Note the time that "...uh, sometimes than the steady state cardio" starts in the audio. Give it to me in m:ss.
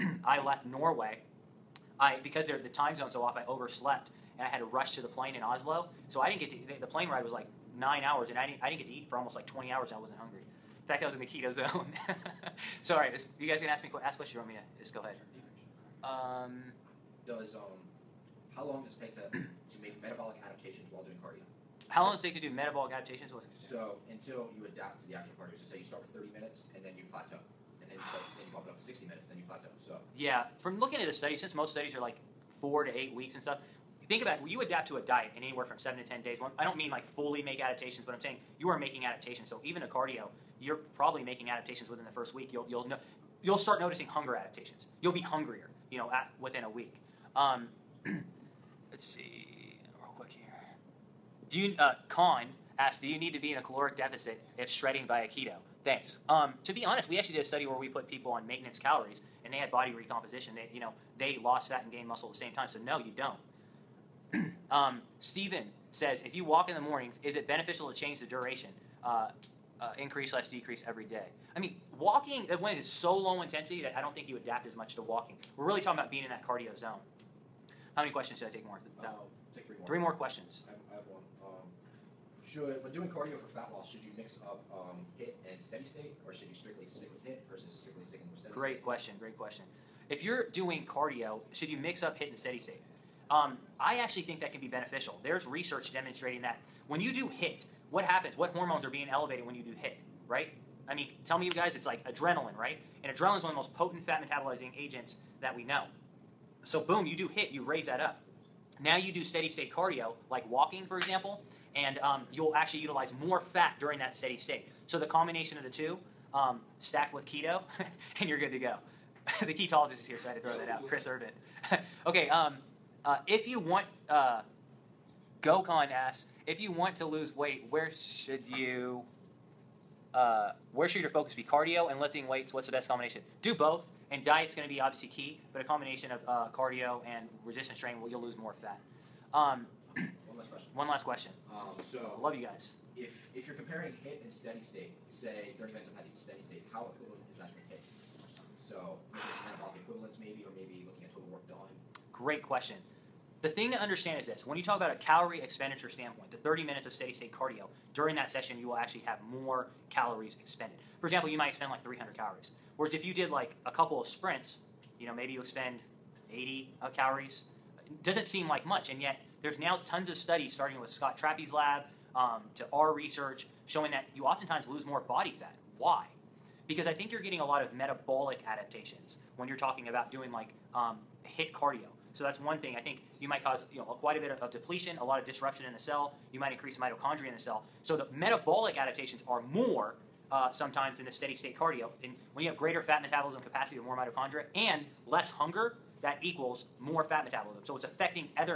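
3:10.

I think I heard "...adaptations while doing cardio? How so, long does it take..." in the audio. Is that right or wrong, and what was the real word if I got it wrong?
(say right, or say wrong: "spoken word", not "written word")
right.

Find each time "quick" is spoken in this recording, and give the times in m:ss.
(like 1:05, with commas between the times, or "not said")
0:50.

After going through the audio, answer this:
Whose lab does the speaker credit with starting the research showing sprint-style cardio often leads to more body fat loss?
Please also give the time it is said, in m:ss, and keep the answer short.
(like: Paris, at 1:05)
Scott Trappe, at 2:50.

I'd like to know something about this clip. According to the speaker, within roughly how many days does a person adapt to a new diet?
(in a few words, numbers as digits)
7 to 10 days.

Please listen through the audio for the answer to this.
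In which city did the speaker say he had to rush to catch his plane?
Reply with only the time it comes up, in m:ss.
0:05.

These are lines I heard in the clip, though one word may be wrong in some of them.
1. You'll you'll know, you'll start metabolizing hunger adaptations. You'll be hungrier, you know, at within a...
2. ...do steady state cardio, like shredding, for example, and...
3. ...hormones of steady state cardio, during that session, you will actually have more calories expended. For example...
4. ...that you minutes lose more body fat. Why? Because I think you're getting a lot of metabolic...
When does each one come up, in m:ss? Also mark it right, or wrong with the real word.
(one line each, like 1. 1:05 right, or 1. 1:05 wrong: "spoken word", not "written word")
1. 0:42 wrong: "noticing", not "metabolizing"
2. 1:49 wrong: "walking", not "shredding"
3. 2:36 wrong: "minutes", not "hormones"
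4. 2:53 wrong: "oftentimes", not "minutes".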